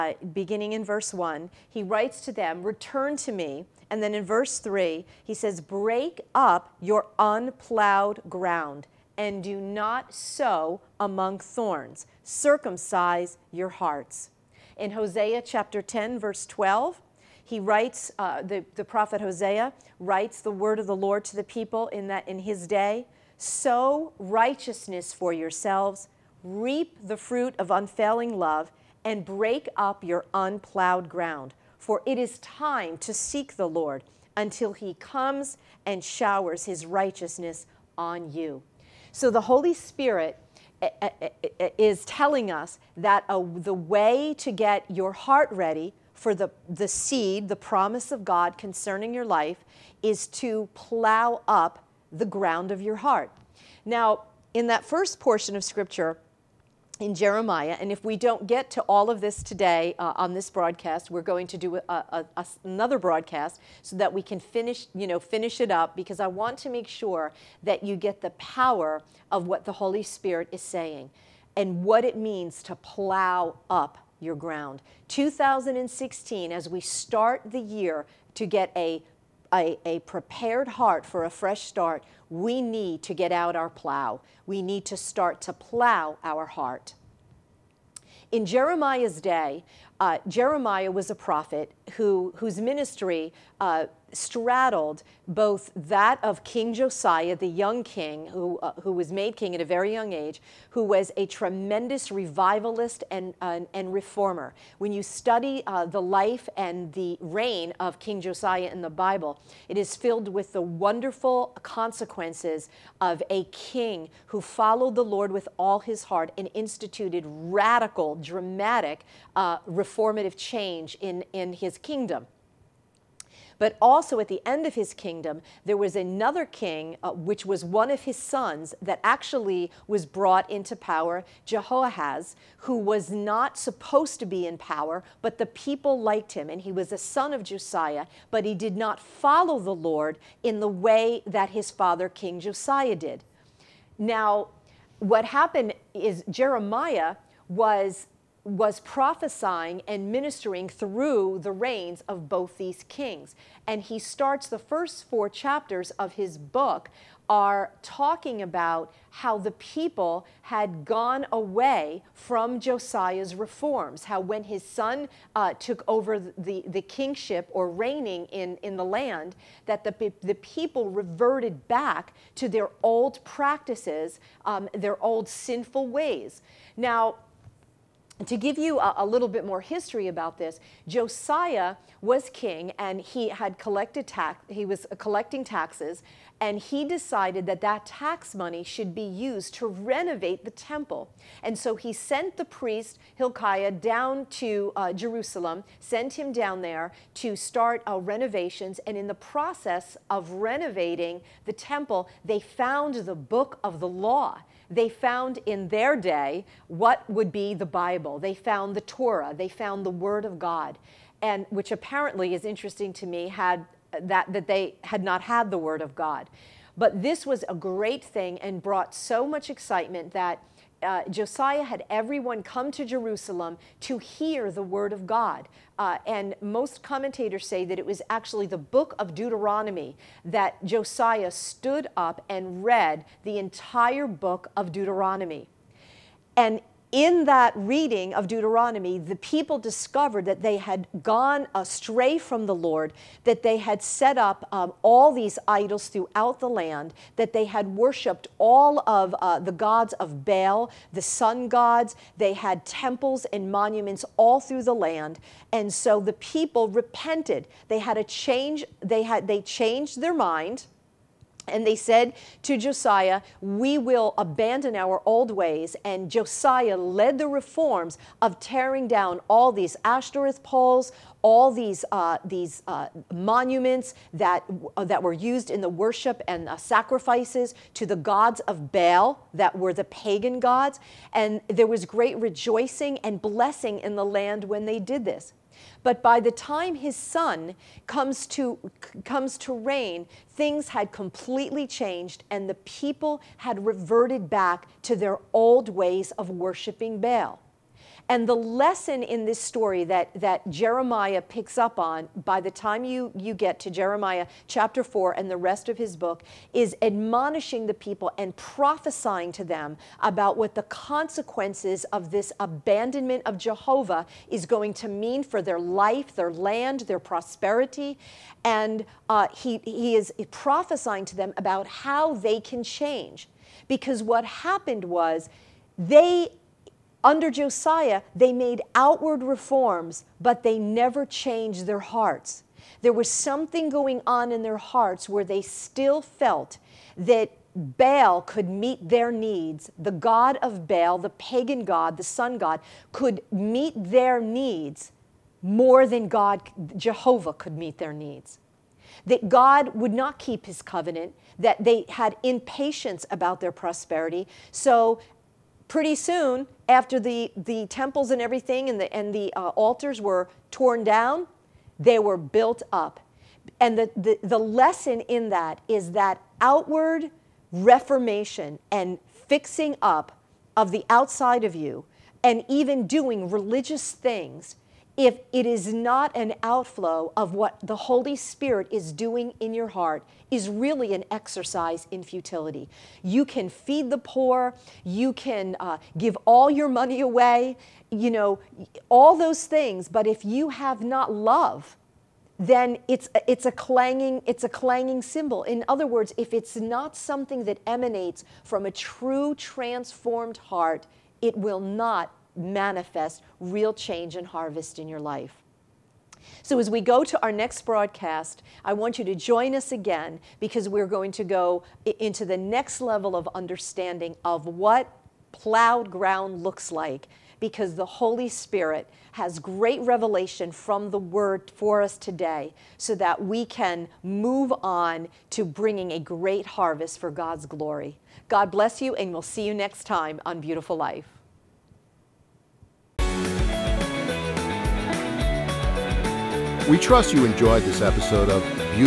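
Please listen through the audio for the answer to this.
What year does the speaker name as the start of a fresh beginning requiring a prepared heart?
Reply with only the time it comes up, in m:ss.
1:15.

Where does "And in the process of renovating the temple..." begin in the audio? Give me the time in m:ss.
3:18.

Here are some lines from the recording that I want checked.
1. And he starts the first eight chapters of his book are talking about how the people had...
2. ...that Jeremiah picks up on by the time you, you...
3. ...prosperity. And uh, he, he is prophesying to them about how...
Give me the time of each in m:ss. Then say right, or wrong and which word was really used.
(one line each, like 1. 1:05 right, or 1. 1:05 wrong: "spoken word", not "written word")
1. 2:33 wrong: "four", not "eight"
2. 5:00 right
3. 5:16 right.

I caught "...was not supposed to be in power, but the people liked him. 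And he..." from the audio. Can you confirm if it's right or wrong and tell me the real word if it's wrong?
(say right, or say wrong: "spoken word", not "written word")
right.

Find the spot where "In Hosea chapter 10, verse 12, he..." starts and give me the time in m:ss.
0:14.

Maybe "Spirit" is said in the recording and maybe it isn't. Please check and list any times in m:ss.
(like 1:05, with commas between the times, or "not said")
0:39, 1:10, 6:18, 6:58.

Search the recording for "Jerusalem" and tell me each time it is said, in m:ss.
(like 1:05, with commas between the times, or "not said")
3:14, 3:42.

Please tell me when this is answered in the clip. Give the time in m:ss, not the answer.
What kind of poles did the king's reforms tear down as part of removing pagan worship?
4:29.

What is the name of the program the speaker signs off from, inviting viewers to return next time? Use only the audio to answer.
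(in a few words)
Beautiful Life.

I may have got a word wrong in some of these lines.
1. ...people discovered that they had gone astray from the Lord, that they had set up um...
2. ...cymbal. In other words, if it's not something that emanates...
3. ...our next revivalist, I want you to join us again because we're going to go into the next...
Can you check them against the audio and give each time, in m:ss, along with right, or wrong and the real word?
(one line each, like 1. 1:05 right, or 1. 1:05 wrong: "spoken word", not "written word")
1. 3:59 right
2. 6:35 right
3. 6:47 wrong: "broadcast", not "revivalist".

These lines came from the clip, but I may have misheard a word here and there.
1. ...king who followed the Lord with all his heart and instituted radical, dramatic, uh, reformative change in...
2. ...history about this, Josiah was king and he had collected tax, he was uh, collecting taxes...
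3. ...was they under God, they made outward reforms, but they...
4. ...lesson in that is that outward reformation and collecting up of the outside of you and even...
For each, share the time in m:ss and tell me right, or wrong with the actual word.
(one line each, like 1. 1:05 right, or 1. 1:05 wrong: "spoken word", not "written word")
1. 1:53 right
2. 2:59 right
3. 5:24 wrong: "Josiah", not "God"
4. 6:04 wrong: "fixing", not "collecting".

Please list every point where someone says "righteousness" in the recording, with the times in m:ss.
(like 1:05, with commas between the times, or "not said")
0:24, 0:36.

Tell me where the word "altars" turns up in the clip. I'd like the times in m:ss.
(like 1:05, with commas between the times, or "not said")
5:59.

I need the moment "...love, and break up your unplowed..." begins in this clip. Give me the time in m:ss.
0:28.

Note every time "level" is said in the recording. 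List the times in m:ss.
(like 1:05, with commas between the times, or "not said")
6:52.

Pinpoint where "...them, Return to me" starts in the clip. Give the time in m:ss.
0:02.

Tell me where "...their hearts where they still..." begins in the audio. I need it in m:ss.
5:34.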